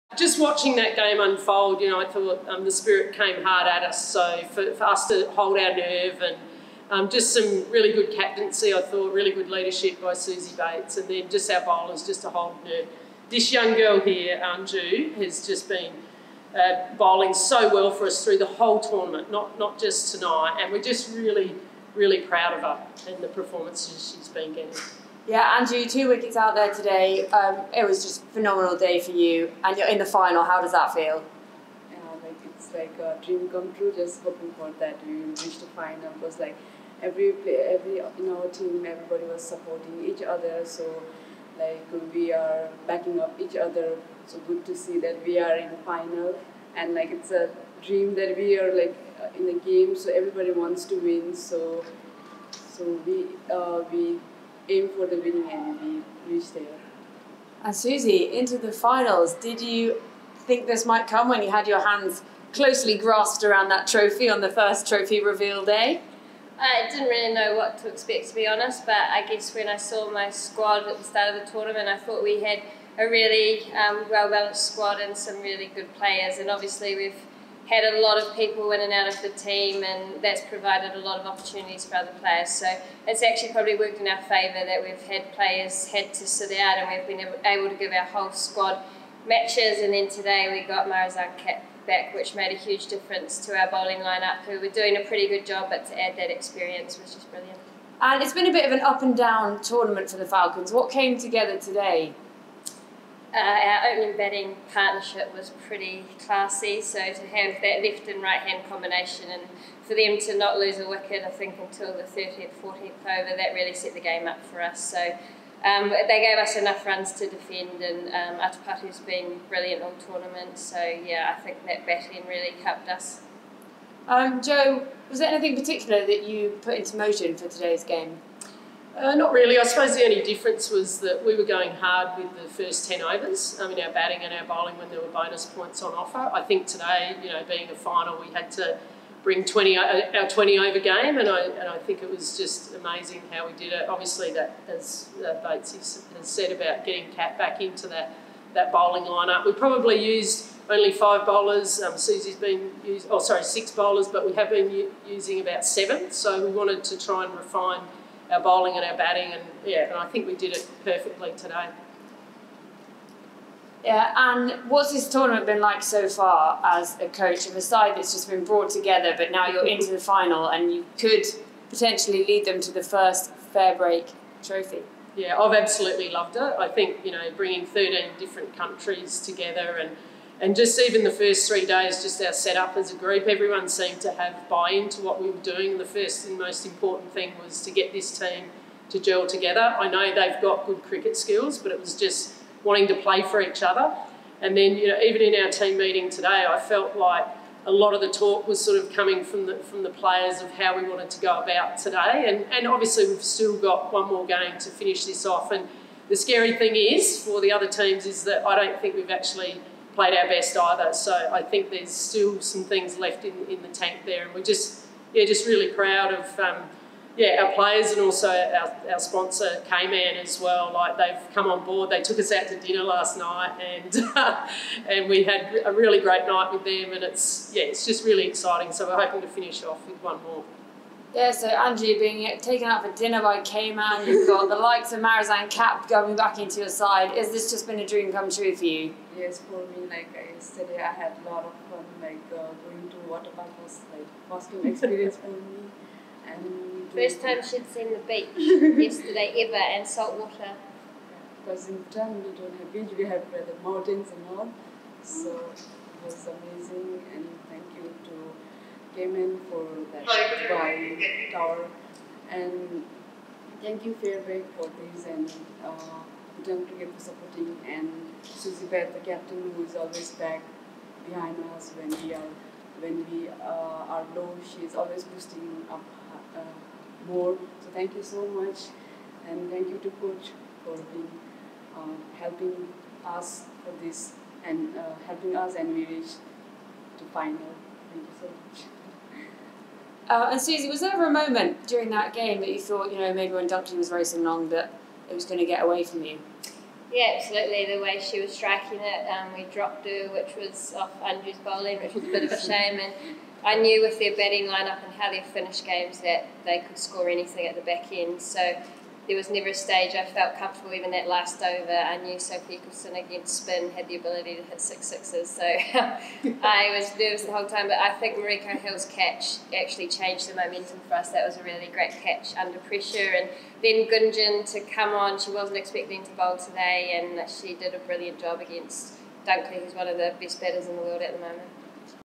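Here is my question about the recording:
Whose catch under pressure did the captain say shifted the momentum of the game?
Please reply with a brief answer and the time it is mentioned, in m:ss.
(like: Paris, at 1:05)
Mariko Hill, at 5:18.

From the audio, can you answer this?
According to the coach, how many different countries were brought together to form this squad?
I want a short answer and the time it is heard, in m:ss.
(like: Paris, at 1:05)
13, at 2:57.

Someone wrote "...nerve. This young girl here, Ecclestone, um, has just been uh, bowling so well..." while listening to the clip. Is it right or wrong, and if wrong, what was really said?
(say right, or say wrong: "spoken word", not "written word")
wrong: "Anju", not "Ecclestone".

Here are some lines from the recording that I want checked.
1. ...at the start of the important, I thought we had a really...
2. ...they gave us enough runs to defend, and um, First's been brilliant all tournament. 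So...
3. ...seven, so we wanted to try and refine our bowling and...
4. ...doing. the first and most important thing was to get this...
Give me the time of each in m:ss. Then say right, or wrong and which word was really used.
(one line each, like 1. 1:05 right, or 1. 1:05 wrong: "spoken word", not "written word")
1. 1:10 wrong: "tournament", not "important"
2. 1:55 wrong: "Athapaththu", not "First"
3. 2:35 right
4. 3:05 right.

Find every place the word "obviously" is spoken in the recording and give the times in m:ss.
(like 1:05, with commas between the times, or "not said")
1:16, 2:23, 3:22.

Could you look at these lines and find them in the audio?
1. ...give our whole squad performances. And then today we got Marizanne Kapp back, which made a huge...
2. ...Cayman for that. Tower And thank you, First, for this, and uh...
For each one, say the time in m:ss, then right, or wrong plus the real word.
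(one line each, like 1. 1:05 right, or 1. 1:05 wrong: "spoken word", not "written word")
1. 1:27 wrong: "matches", not "performances"
2. 4:18 wrong: "FairBreak", not "First".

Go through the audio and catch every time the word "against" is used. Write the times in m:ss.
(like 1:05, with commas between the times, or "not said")
5:13, 5:28.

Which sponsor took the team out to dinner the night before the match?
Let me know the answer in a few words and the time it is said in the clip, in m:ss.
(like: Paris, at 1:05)
K-Man, at 3:39.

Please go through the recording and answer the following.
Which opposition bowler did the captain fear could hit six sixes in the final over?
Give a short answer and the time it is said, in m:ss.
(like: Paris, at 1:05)
Sophie Ecclestone, at 5:12.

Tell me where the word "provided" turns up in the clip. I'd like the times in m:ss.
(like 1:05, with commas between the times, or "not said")
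1:20.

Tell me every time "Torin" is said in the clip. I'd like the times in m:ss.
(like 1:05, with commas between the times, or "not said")
not said.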